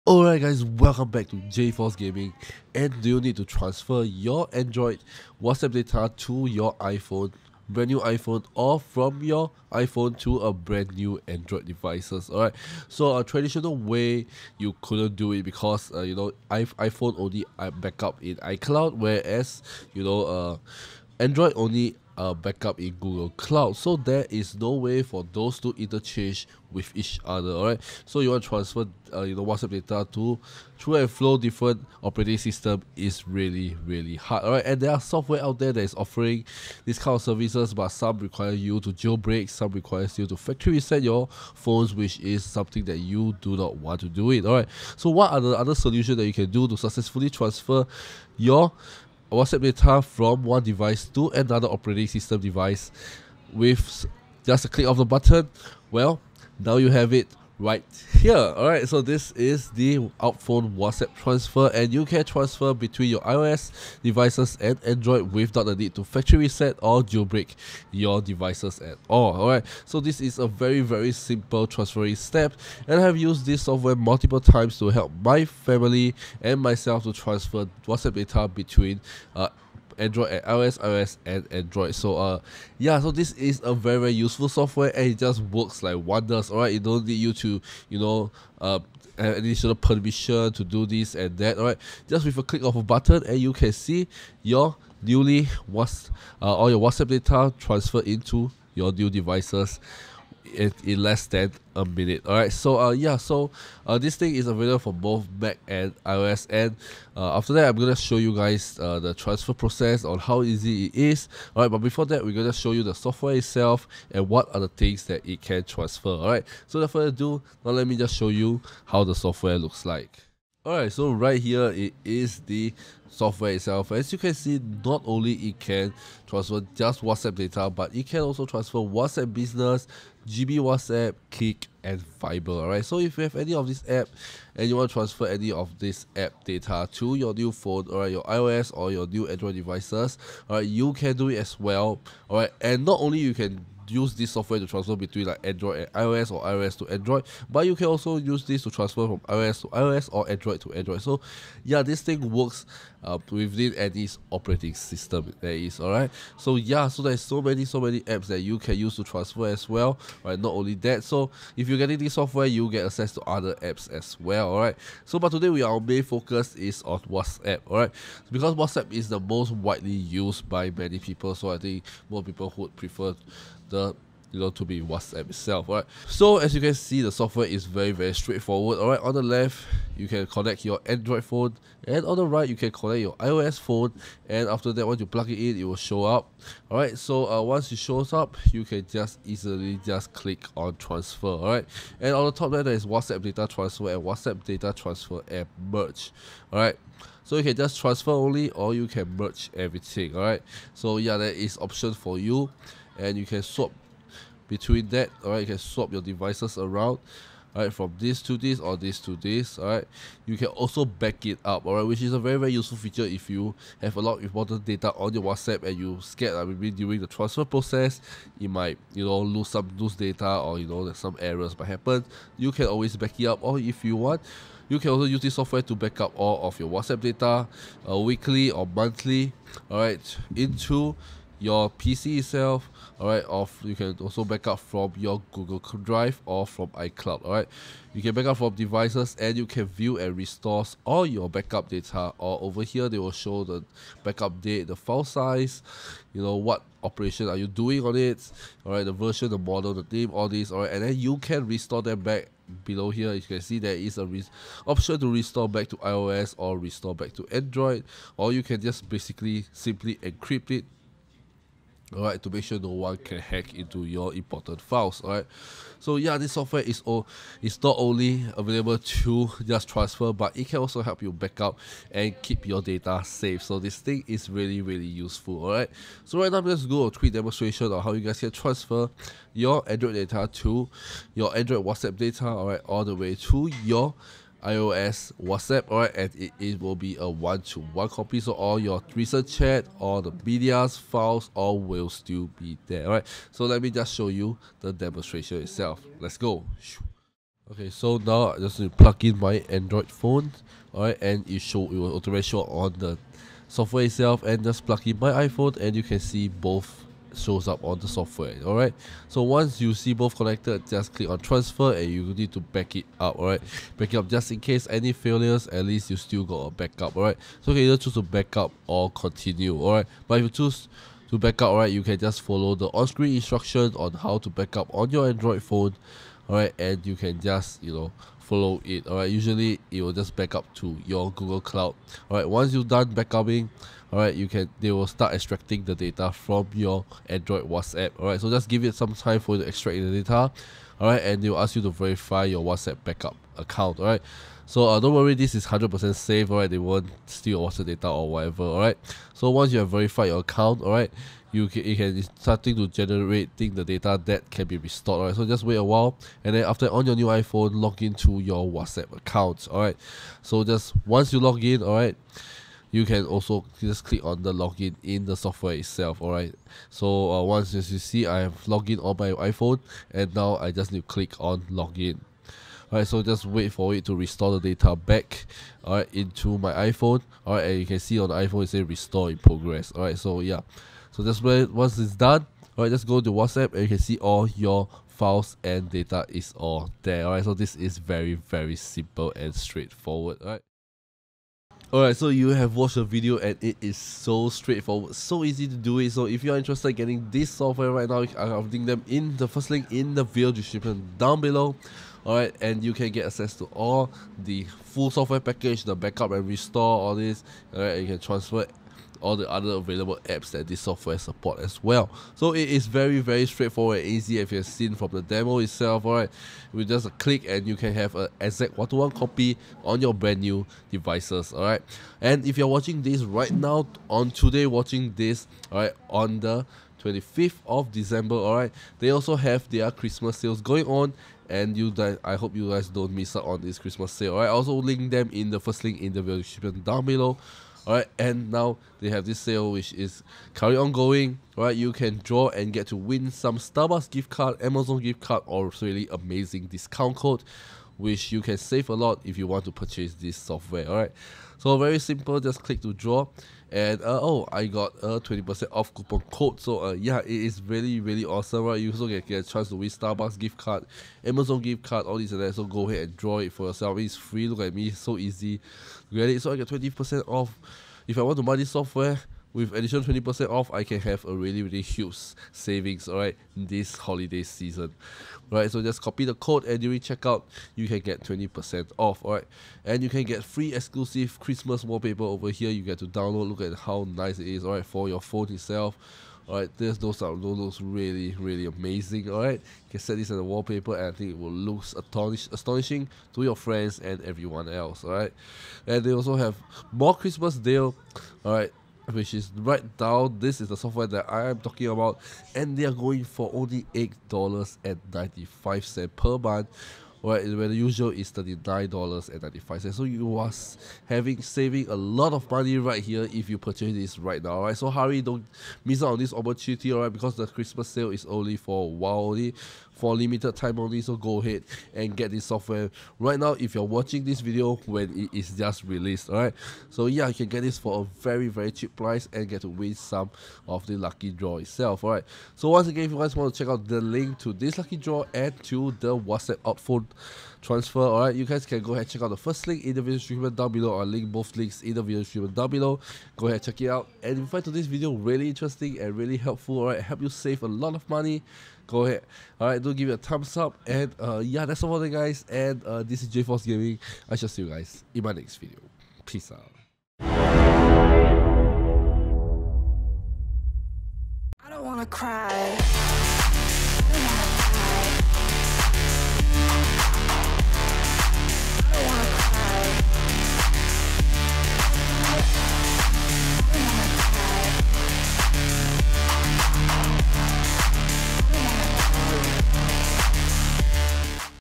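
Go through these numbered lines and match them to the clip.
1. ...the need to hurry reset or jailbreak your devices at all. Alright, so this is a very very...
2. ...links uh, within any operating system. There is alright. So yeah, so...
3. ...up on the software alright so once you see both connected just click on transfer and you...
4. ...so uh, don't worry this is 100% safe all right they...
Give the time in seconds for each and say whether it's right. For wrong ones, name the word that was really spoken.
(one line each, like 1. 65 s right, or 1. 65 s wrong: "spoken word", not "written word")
1. 65 s wrong: "factory", not "hurry"
2. 152 s wrong: "works", not "links"
3. 307 s right
4. 344 s right.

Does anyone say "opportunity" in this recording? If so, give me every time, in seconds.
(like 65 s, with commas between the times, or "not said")
516 s.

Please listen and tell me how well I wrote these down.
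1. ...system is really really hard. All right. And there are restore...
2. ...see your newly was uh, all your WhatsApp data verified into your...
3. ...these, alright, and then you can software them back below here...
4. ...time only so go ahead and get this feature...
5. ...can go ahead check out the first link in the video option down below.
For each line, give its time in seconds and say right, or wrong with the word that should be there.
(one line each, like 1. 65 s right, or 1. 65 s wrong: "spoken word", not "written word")
1. 32 s wrong: "software", not "restore"
2. 93 s wrong: "transferred", not "verified"
3. 250 s wrong: "restore", not "software"
4. 520 s wrong: "software", not "feature"
5. 538 s wrong: "description", not "option".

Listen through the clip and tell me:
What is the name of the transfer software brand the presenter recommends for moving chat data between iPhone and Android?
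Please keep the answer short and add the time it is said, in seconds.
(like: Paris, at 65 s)
UltFone, at 59 s.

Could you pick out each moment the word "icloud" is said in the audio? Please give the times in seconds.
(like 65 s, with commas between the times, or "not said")
18 s, 236 s.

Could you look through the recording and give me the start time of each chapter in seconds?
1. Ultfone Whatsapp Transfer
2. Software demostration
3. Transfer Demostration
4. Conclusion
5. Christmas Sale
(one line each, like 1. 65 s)
1. 58 s
2. 120 s
3. 296 s
4. 390 s
5. 422 s.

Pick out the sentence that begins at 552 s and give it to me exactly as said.
And uh, this is J Force Gaming.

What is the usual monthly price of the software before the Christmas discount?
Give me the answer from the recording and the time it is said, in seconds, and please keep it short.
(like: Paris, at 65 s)
$39.95, at 508 s.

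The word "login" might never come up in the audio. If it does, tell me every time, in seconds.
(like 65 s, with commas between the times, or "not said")
364 s, 371 s.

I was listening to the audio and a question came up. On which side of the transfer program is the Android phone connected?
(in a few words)
The left.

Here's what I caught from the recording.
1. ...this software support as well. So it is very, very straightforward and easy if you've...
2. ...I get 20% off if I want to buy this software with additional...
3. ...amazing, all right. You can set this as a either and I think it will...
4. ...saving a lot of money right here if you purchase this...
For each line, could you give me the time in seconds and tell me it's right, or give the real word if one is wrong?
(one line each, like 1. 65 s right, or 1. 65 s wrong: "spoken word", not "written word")
1. 410 s right
2. 466 s right
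3. 488 s wrong: "wallpaper", not "either"
4. 511 s right.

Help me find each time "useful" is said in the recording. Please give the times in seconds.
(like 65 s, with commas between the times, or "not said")
84 s, 212 s, 274 s.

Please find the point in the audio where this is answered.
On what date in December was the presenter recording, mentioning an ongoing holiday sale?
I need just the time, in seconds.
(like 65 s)
426 s.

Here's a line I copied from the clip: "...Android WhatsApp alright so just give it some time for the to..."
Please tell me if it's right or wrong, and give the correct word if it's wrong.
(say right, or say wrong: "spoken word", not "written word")
right.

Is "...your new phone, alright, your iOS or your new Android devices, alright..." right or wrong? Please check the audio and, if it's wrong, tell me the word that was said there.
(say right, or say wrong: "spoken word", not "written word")
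right.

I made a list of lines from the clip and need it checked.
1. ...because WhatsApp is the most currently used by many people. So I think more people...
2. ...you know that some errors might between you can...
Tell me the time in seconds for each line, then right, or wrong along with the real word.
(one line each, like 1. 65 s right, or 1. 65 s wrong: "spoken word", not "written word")
1. 168 s wrong: "widely", not "currently"
2. 220 s wrong: "happen", not "between".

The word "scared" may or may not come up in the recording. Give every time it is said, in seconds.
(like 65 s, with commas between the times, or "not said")
216 s.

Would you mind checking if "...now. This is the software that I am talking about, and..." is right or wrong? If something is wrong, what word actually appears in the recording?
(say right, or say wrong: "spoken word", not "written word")
right.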